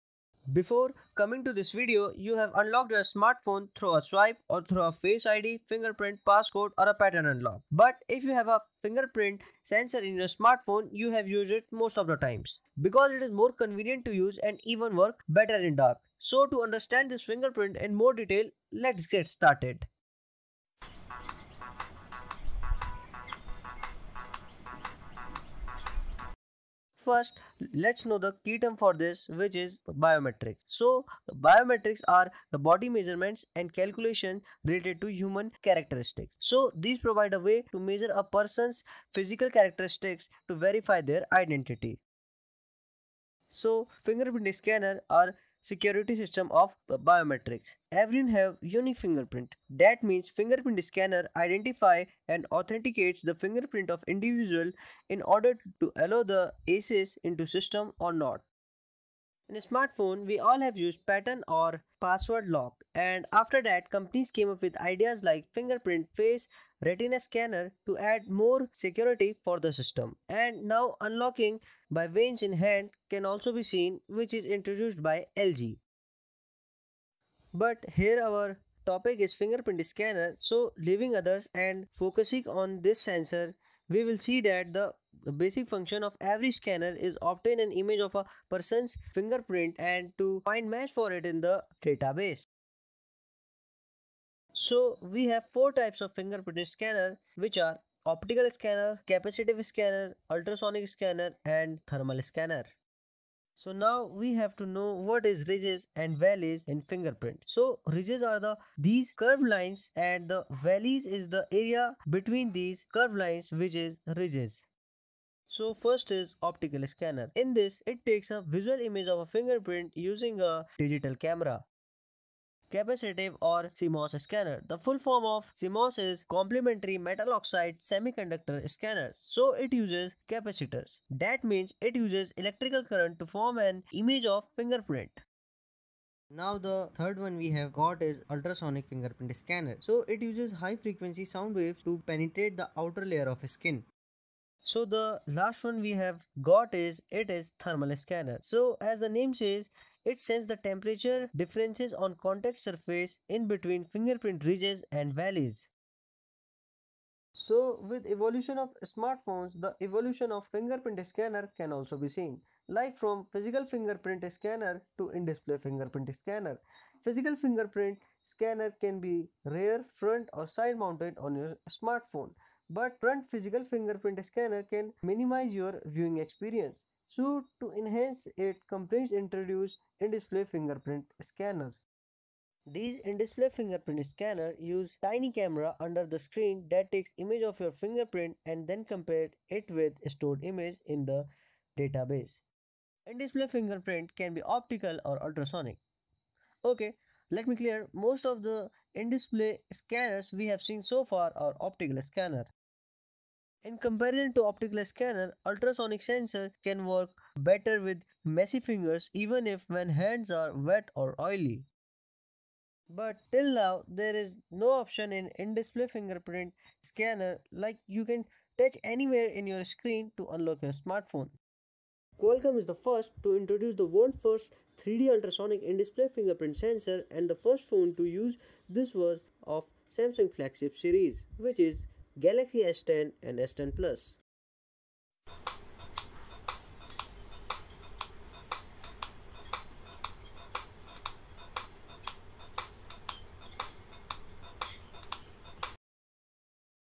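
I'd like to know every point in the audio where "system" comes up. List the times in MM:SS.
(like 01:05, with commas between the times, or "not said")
00:46, 00:57, 01:09.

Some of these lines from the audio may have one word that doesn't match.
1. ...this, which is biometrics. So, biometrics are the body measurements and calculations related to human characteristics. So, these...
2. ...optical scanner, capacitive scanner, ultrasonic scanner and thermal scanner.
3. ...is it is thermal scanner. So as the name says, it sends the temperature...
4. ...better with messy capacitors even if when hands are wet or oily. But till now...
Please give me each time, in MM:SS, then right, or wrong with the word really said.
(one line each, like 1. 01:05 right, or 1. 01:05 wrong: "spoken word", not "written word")
1. 00:28 right
2. 01:38 right
3. 02:26 right
4. 03:27 wrong: "fingers", not "capacitors".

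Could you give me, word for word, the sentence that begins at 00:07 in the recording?
But if you have a fingerprint sensor in your smartphone, you have used it most of the times.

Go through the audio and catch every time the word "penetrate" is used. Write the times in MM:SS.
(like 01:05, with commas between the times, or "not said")
02:22.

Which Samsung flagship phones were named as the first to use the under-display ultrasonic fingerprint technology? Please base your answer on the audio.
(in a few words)
Galaxy S10 and S10 Plus.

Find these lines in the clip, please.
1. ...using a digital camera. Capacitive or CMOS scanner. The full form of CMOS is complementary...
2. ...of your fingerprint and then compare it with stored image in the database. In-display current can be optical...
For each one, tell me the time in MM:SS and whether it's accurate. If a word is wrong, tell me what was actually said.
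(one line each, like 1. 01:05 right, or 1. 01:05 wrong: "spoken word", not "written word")
1. 01:59 right
2. 03:07 wrong: "fingerprint", not "current".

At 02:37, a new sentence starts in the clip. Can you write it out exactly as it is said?
So with evolution of smartphones, the evolution of fingerprint scanner can also be seen.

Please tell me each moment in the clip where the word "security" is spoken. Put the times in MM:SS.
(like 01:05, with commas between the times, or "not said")
00:45, 01:08.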